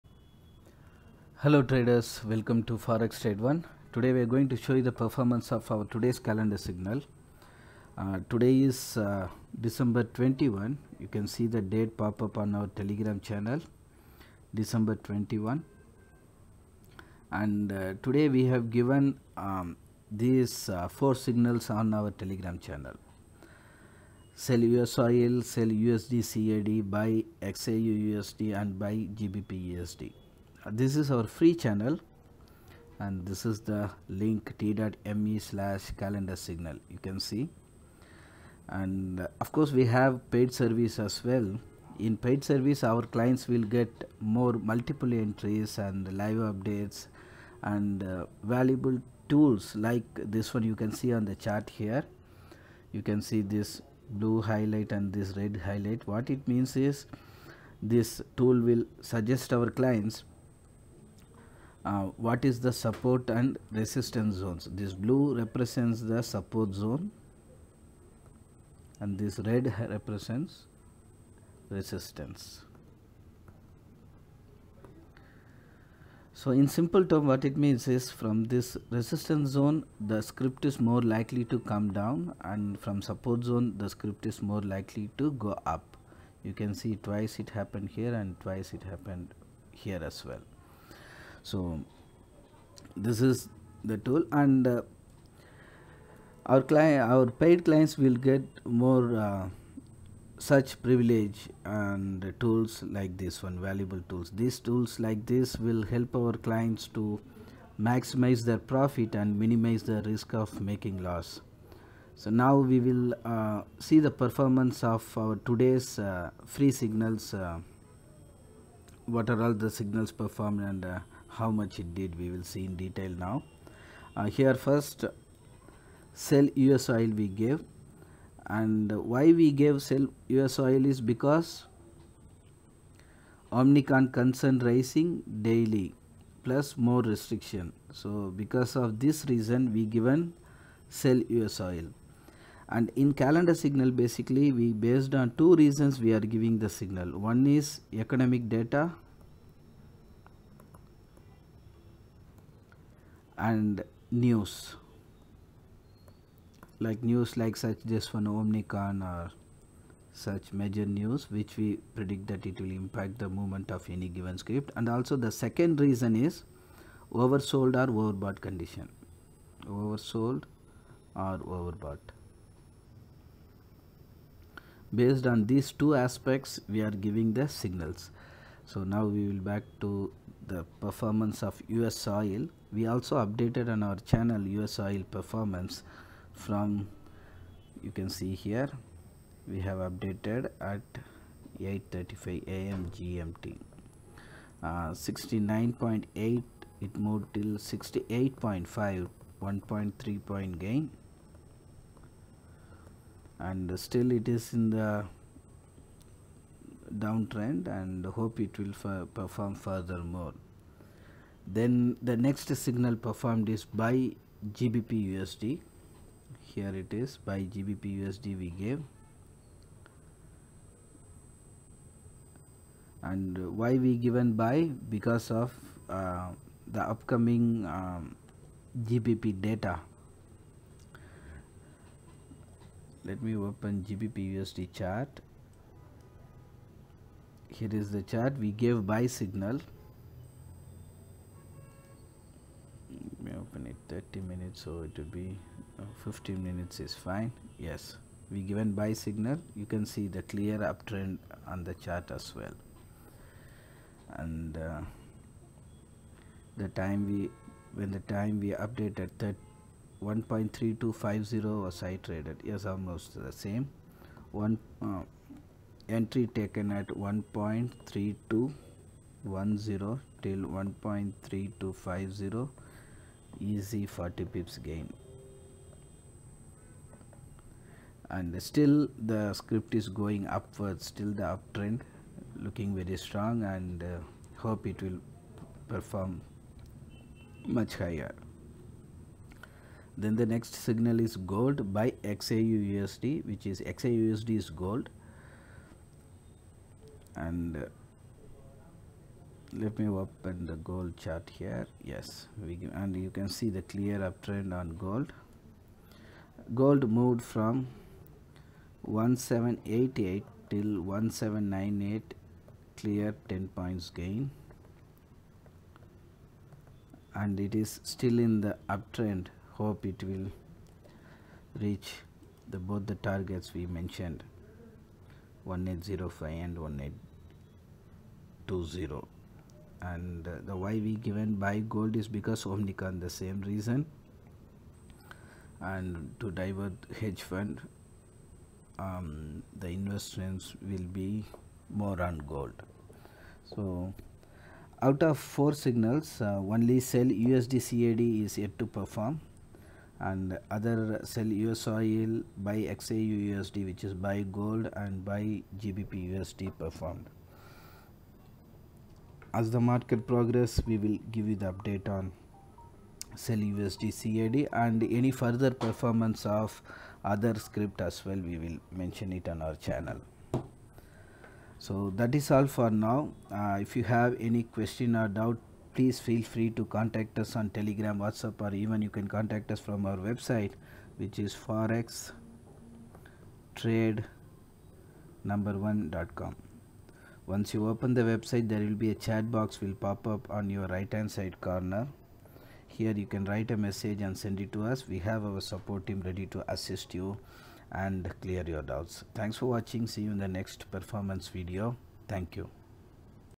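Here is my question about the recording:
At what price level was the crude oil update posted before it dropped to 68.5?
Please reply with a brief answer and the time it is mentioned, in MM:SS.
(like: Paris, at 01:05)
69.8, at 03:14.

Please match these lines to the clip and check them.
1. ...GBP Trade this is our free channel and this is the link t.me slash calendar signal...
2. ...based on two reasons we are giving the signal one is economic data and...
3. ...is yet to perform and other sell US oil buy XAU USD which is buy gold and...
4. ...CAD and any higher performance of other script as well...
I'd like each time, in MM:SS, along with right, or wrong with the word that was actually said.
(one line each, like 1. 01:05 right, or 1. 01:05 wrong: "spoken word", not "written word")
1. 00:28 wrong: "USD", not "Trade"
2. 02:24 right
3. 05:48 right
4. 06:04 wrong: "further", not "higher".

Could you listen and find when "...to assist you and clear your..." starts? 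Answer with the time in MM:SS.
06:36.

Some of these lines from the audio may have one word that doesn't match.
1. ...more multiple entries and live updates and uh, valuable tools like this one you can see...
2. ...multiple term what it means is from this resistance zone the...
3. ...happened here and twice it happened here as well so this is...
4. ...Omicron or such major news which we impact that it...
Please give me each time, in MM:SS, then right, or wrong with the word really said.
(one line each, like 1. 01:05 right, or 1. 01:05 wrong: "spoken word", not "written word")
1. 00:44 right
2. 01:16 wrong: "simple", not "multiple"
3. 01:27 right
4. 02:38 wrong: "predict", not "impact".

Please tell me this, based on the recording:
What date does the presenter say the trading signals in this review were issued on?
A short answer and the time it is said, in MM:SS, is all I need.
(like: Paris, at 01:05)
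December 21, at 00:09.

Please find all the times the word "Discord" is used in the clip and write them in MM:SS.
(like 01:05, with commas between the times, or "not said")
not said.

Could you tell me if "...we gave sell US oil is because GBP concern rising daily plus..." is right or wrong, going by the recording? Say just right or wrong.
wrong.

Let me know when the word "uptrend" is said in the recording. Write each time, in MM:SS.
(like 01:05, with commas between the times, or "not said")
04:10, 04:41, 05:03, 05:18.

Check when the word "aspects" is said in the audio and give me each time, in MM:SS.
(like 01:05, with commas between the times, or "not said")
02:55.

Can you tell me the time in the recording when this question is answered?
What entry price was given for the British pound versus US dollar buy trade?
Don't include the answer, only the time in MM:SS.
04:26.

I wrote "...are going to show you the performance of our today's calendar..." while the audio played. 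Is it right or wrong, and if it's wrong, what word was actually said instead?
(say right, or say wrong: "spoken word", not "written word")
right.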